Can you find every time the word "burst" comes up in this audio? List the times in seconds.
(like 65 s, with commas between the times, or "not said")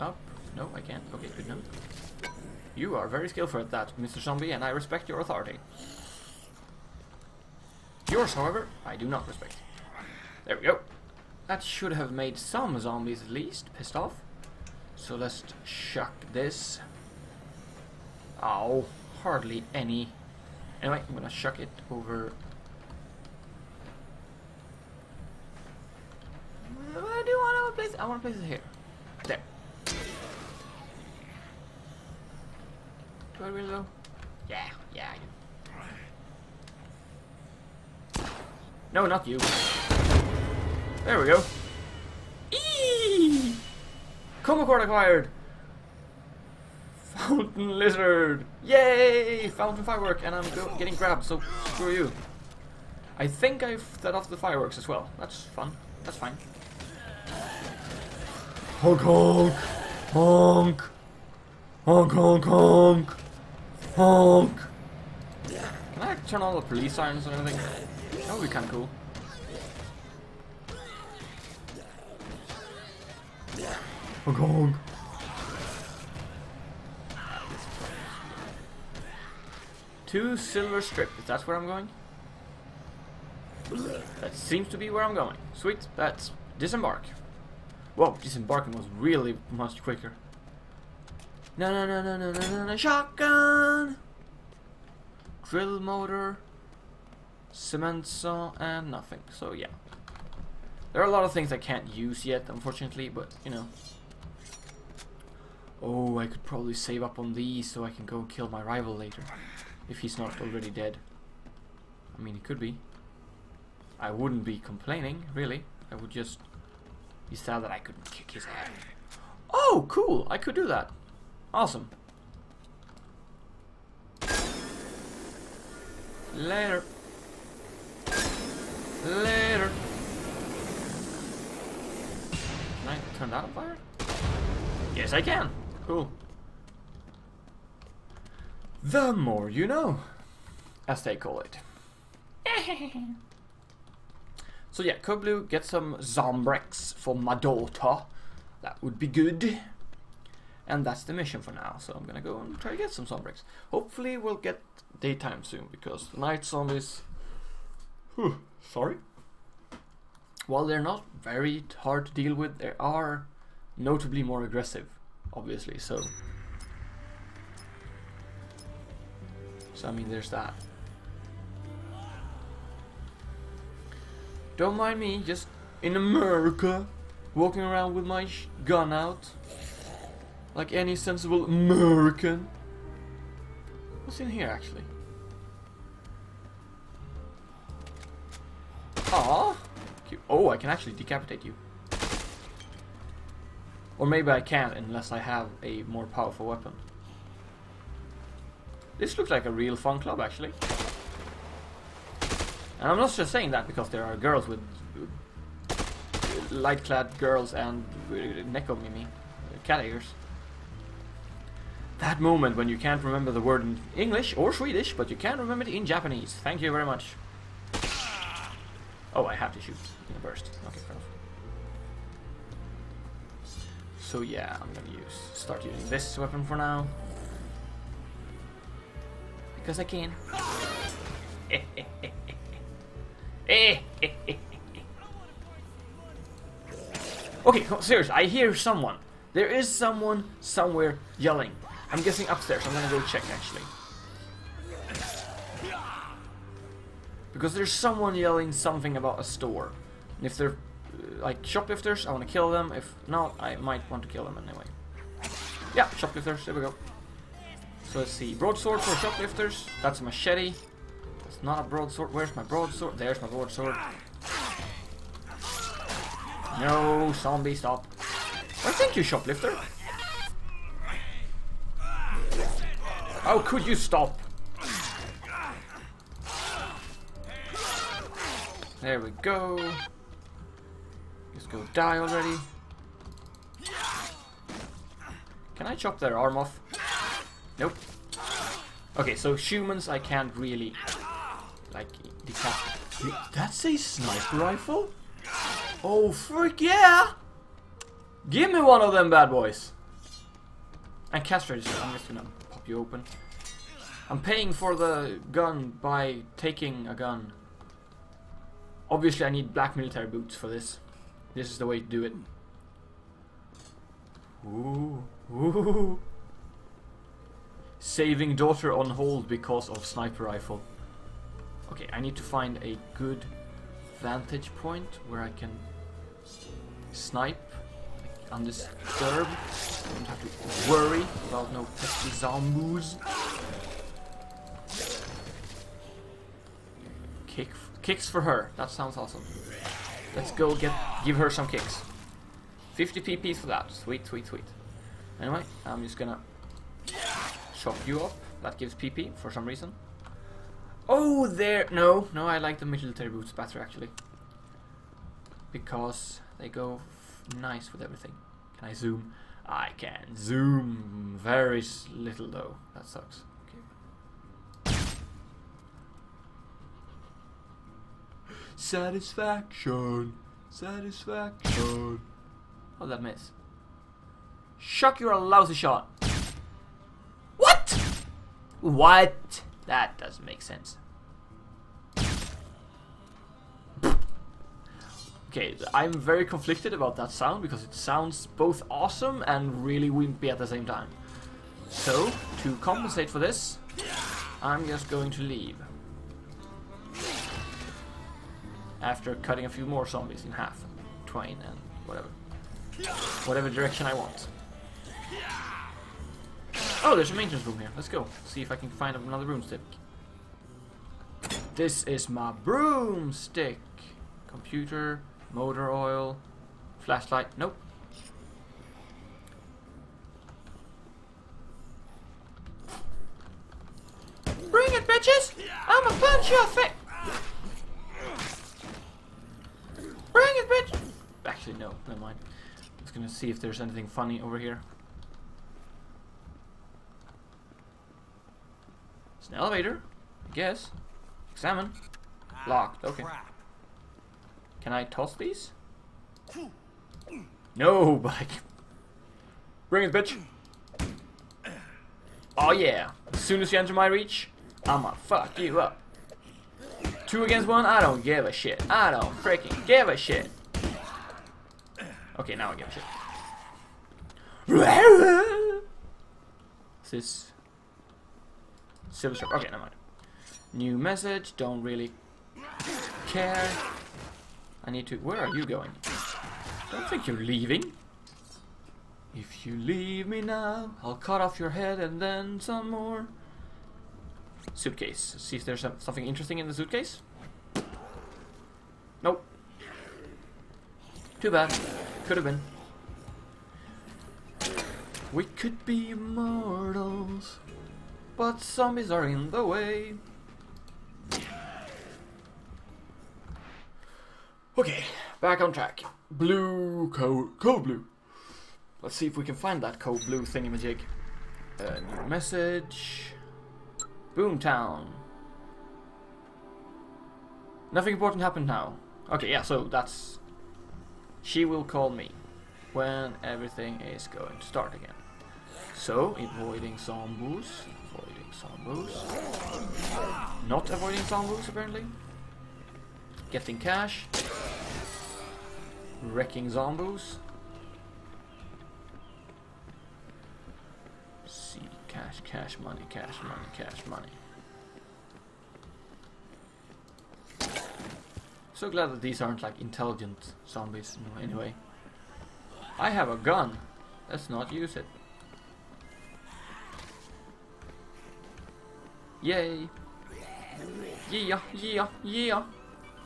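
220 s.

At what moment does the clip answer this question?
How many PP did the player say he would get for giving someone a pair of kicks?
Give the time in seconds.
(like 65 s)
342 s.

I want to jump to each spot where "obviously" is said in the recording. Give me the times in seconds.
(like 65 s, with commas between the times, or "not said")
165 s, 308 s.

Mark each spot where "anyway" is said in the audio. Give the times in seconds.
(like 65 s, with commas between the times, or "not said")
20 s, 254 s, 345 s, 551 s.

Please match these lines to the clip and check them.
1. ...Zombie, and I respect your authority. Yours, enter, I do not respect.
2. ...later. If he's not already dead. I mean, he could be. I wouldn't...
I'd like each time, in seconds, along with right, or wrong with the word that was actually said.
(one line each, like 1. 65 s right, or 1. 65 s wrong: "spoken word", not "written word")
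1. 4 s wrong: "however", not "enter"
2. 108 s right.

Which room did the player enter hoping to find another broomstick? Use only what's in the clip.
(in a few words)
maintenance room.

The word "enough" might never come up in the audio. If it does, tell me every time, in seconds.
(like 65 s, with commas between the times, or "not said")
1 s, 220 s.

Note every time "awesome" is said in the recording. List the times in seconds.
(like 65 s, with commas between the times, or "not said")
121 s, 338 s, 388 s.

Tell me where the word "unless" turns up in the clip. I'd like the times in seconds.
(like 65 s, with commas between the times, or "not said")
194 s.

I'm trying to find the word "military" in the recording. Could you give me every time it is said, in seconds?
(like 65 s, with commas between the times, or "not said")
309 s, 352 s.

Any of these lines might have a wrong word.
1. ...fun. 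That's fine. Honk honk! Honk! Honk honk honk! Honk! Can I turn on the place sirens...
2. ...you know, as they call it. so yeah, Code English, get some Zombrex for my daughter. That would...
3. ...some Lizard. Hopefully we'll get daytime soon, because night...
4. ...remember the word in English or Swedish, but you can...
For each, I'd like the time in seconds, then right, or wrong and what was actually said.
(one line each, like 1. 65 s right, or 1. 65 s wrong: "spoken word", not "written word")
1. 55 s wrong: "police", not "place"
2. 139 s wrong: "Blue", not "English"
3. 152 s wrong: "Zombrex", not "Lizard"
4. 213 s right.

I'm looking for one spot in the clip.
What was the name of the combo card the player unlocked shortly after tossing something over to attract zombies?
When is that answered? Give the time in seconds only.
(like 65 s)
47 s.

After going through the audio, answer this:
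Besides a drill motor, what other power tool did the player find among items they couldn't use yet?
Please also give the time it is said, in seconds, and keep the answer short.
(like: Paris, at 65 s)
cement saw, at 97 s.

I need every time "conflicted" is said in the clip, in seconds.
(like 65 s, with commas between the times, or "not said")
386 s.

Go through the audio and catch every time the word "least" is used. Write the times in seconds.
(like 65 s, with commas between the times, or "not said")
13 s.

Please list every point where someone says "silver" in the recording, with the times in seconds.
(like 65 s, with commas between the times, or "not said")
80 s, 468 s.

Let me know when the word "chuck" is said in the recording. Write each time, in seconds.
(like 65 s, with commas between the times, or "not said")
15 s, 21 s.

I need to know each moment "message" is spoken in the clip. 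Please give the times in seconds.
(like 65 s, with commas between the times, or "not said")
470 s, 512 s.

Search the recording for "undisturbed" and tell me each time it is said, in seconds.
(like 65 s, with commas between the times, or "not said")
328 s.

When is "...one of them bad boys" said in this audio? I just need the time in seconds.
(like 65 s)
298 s.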